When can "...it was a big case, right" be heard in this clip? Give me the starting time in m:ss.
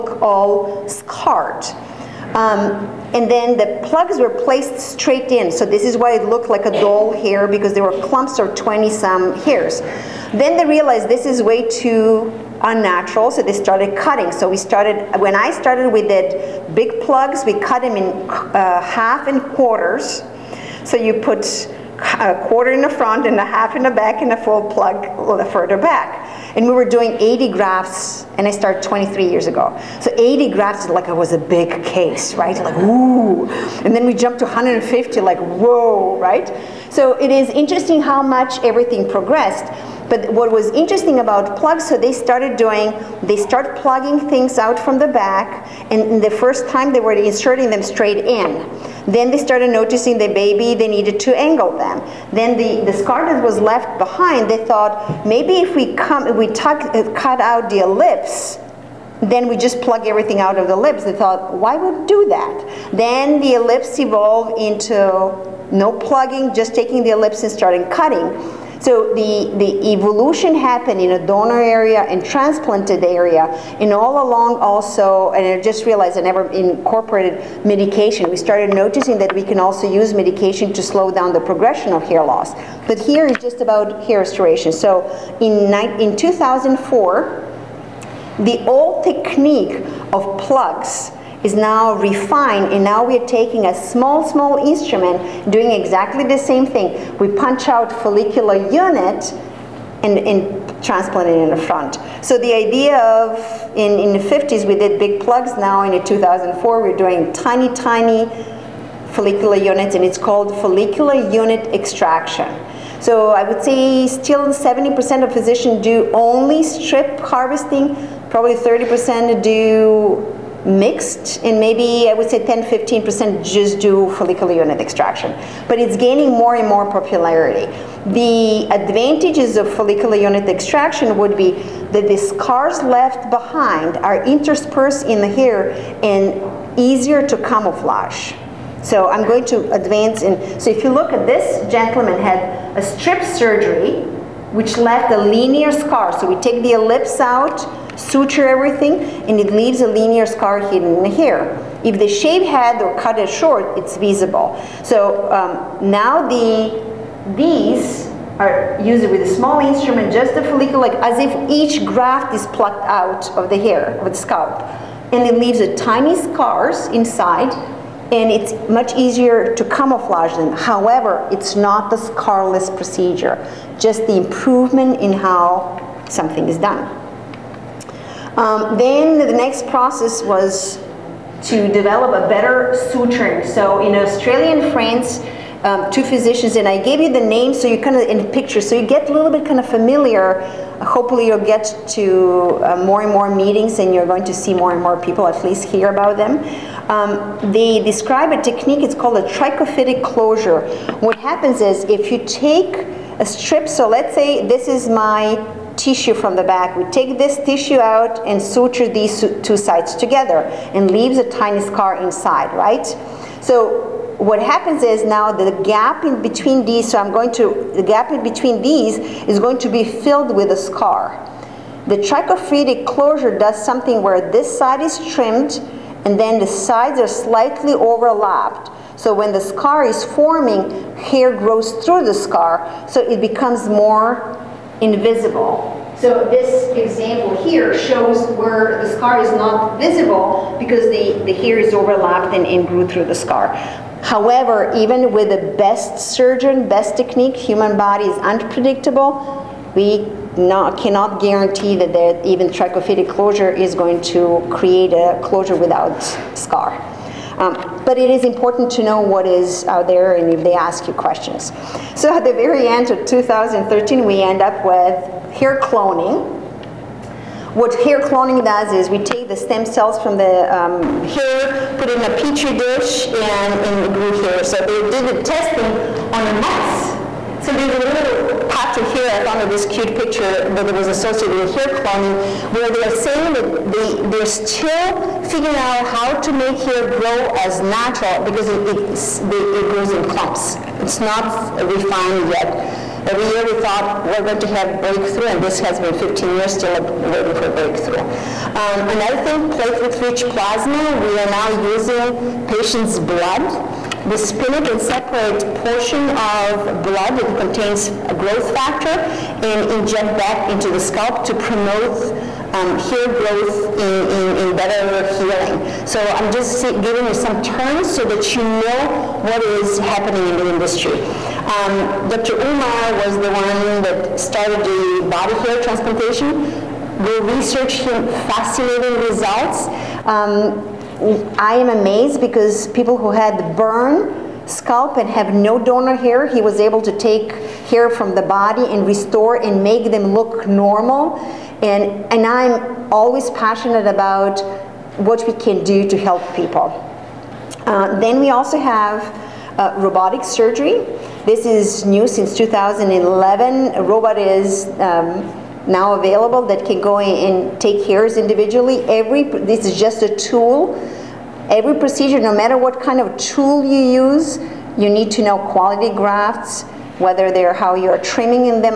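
0:31.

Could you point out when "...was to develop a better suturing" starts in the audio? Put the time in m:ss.
3:00.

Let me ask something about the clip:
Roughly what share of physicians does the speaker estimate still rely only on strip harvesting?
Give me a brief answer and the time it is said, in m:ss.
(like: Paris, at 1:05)
70%, at 1:54.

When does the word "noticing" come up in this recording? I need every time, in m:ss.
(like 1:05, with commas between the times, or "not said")
0:49, 1:18.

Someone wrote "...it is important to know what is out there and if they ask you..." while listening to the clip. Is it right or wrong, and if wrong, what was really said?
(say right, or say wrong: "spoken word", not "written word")
right.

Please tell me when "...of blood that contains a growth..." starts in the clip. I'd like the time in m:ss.
5:06.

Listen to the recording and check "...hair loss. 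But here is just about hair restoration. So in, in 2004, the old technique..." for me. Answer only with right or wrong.
right.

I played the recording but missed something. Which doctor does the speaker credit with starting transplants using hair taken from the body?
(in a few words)
Dr. Umar.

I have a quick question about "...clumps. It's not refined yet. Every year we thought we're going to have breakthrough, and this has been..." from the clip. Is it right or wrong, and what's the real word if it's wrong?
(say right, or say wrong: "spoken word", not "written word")
right.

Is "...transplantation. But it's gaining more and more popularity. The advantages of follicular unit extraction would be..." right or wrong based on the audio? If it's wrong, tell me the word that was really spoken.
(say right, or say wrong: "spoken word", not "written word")
wrong: "extraction", not "transplantation".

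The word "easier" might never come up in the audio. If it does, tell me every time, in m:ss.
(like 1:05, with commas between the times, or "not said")
2:16, 2:48.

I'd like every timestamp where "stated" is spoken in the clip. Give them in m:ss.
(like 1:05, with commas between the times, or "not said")
not said.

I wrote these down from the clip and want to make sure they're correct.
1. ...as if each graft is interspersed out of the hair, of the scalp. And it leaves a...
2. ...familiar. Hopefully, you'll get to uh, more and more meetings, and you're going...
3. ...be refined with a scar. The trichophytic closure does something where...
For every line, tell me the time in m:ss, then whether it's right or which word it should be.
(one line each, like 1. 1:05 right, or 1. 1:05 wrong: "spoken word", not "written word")
1. 2:40 wrong: "plucked", not "interspersed"
2. 3:09 right
3. 3:39 wrong: "filled", not "refined".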